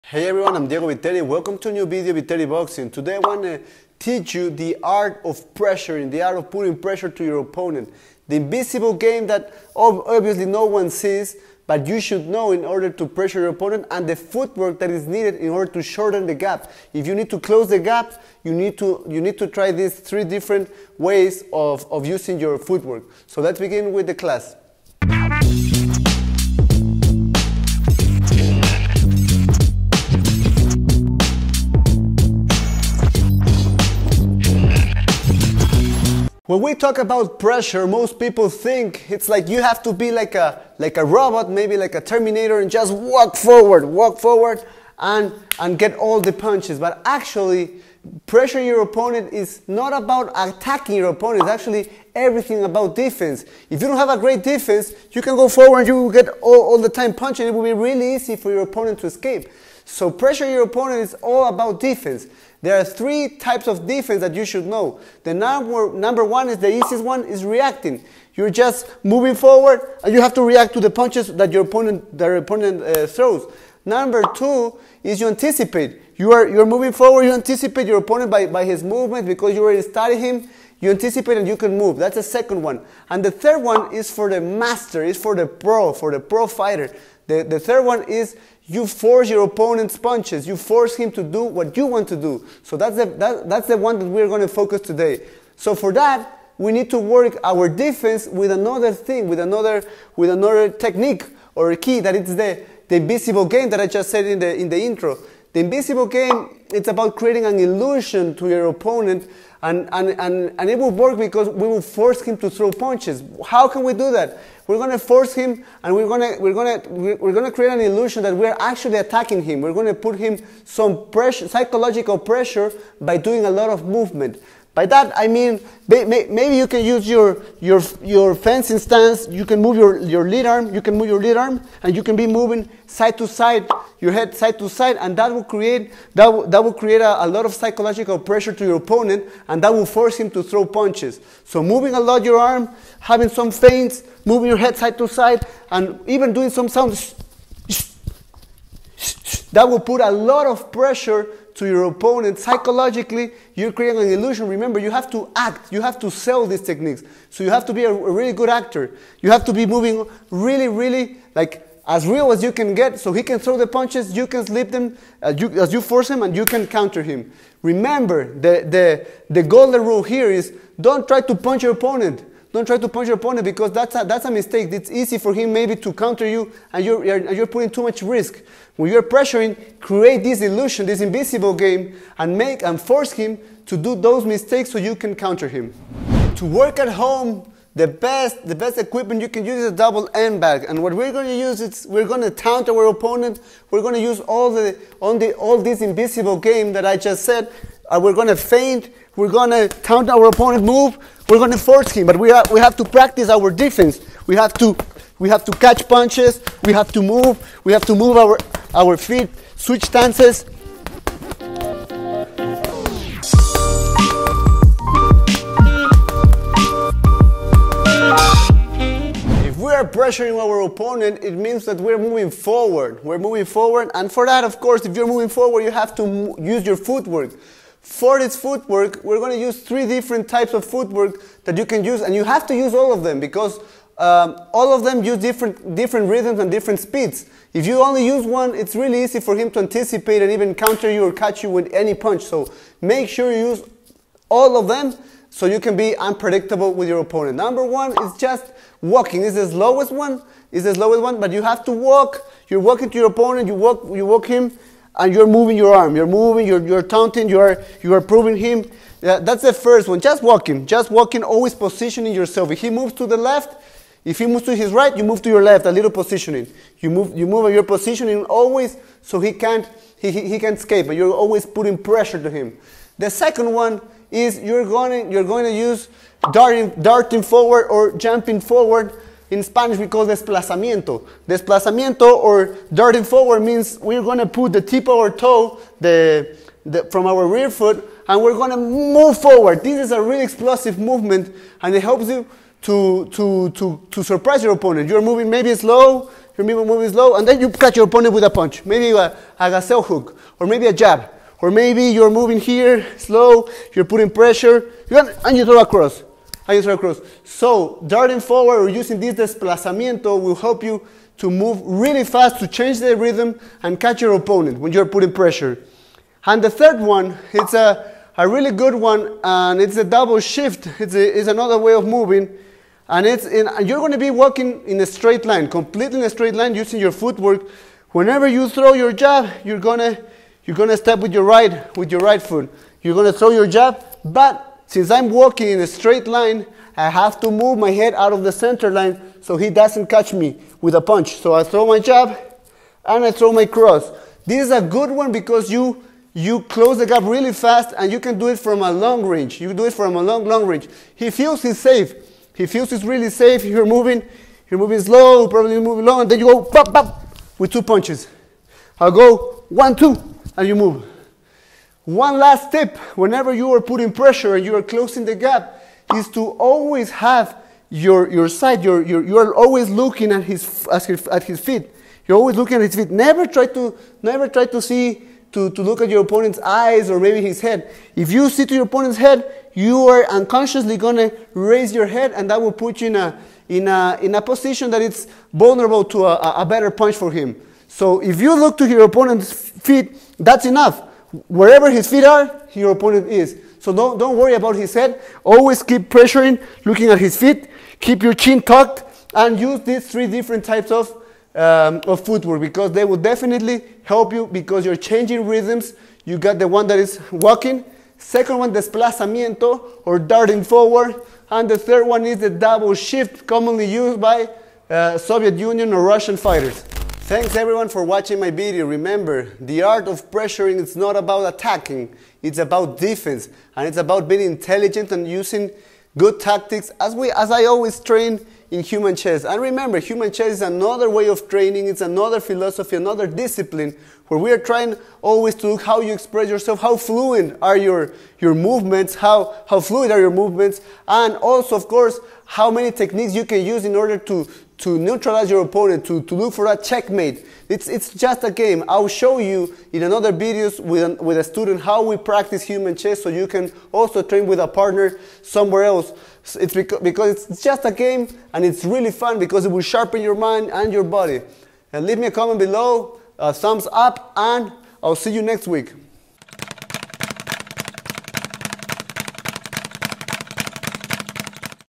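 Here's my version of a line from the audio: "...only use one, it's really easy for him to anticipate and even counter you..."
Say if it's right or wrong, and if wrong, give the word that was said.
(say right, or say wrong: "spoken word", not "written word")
right.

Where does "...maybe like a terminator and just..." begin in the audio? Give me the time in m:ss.
0:41.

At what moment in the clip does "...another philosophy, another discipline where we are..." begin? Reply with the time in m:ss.
7:11.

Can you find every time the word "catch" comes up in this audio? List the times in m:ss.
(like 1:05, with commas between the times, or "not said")
3:25, 4:01, 4:57, 5:13, 5:39.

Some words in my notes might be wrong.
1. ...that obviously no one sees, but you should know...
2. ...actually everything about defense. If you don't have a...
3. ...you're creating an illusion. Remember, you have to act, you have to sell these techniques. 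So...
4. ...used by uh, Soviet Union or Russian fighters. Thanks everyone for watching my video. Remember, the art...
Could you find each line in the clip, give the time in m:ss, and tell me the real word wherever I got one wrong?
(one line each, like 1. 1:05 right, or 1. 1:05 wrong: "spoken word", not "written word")
1. 0:09 right
2. 0:51 right
3. 2:33 right
4. 6:53 right.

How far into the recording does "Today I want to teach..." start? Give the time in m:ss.
0:02.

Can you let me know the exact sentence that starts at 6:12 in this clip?
You're always looking at his feet.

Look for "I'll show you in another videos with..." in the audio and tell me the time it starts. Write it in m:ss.
7:28.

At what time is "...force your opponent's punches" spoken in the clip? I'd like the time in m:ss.
1:28.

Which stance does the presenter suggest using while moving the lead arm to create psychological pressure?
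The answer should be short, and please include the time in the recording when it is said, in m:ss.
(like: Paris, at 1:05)
fencing stance, at 2:08.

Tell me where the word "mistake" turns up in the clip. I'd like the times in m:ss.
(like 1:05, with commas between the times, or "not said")
2:54, 3:04.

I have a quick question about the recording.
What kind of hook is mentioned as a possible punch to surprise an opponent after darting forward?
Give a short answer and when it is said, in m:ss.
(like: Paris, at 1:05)
gazelle hook, at 4:59.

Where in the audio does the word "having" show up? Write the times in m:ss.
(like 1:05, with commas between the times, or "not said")
2:23.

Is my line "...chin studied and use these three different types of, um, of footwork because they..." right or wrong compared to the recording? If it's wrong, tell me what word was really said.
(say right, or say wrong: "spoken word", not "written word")
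wrong: "tucked", not "studied".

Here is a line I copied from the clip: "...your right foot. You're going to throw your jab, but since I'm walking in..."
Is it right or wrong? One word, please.
right.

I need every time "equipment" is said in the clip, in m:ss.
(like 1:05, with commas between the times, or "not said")
3:08.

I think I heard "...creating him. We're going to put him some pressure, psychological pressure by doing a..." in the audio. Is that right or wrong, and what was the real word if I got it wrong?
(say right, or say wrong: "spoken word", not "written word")
wrong: "attacking", not "creating".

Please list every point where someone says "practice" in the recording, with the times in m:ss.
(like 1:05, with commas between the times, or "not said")
3:22, 7:31.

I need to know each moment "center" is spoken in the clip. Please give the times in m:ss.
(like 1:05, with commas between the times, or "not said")
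5:38.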